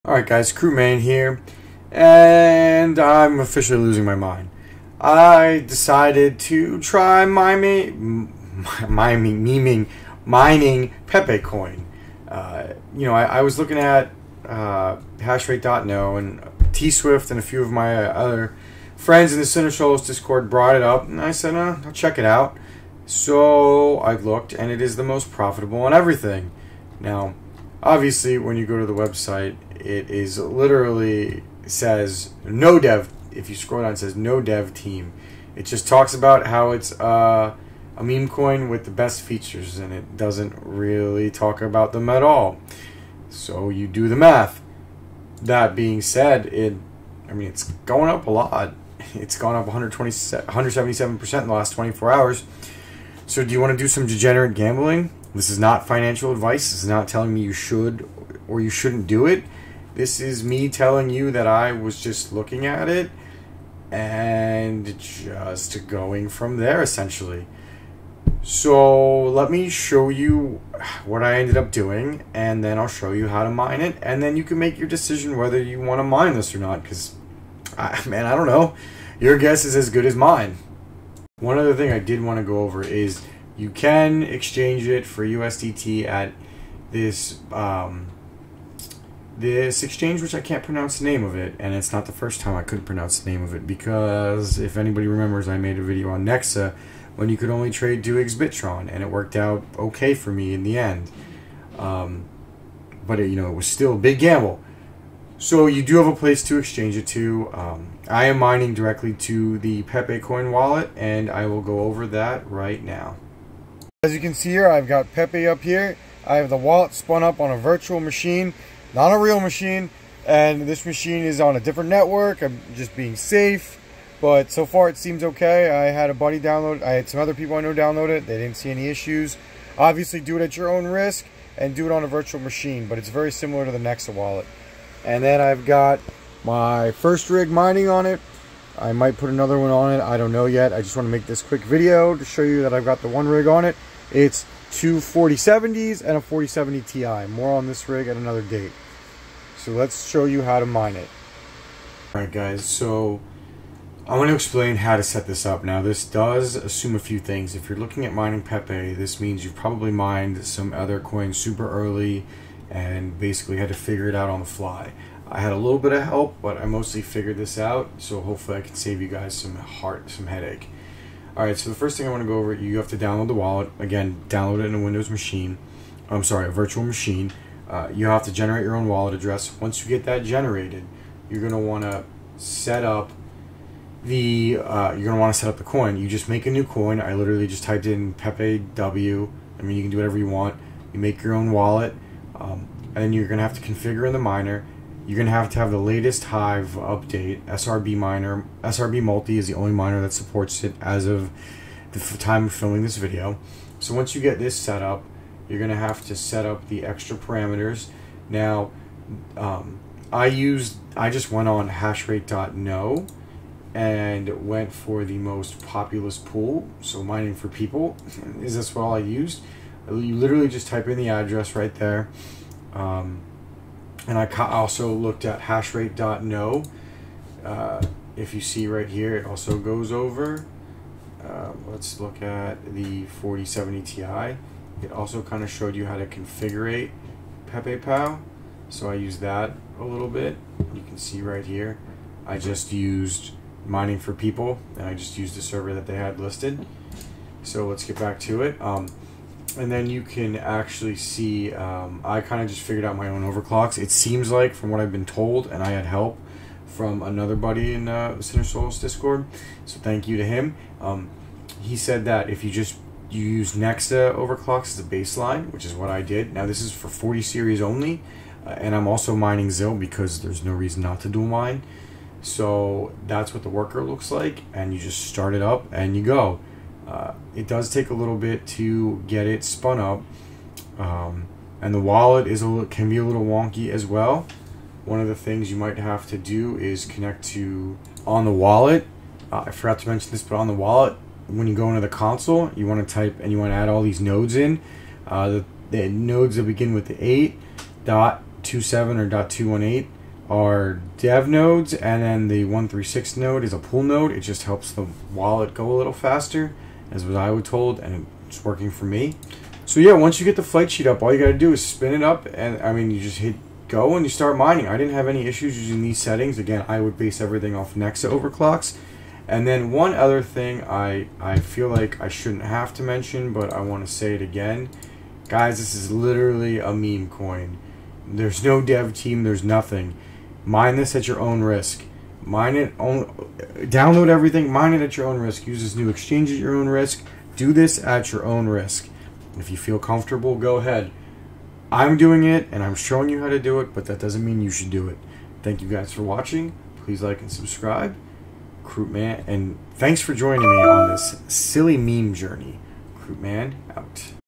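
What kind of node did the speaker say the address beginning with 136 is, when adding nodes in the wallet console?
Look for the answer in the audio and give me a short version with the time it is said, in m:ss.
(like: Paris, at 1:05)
pool node, at 5:03.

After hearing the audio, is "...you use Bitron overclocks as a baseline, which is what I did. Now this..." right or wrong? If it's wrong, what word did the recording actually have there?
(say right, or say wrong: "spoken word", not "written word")
wrong: "Nexa", not "Bitron".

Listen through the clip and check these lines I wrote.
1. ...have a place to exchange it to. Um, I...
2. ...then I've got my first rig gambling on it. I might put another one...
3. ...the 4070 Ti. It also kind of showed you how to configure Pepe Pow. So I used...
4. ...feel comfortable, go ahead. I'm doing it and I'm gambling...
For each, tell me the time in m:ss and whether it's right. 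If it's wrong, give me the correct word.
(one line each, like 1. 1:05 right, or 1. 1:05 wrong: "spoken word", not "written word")
1. 1:45 right
2. 2:15 wrong: "mining", not "gambling"
3. 3:52 right
4. 5:39 wrong: "showing", not "gambling".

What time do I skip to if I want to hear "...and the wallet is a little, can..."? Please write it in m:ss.
4:41.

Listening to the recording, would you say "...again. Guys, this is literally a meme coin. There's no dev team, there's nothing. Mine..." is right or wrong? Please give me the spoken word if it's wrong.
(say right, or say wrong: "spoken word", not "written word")
right.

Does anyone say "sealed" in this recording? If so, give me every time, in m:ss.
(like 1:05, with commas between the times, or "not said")
not said.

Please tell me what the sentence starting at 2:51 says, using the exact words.
All right, so the first thing I want to go over, you have to download the wallet.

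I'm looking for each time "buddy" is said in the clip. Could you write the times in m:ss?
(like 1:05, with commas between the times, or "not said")
2:06, 4:17.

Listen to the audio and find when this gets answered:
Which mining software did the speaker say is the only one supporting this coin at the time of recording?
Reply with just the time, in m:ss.
3:18.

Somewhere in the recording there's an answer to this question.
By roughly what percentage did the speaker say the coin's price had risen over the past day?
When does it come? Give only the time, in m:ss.
0:50.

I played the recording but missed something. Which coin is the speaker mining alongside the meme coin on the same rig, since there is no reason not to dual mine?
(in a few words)
Zil.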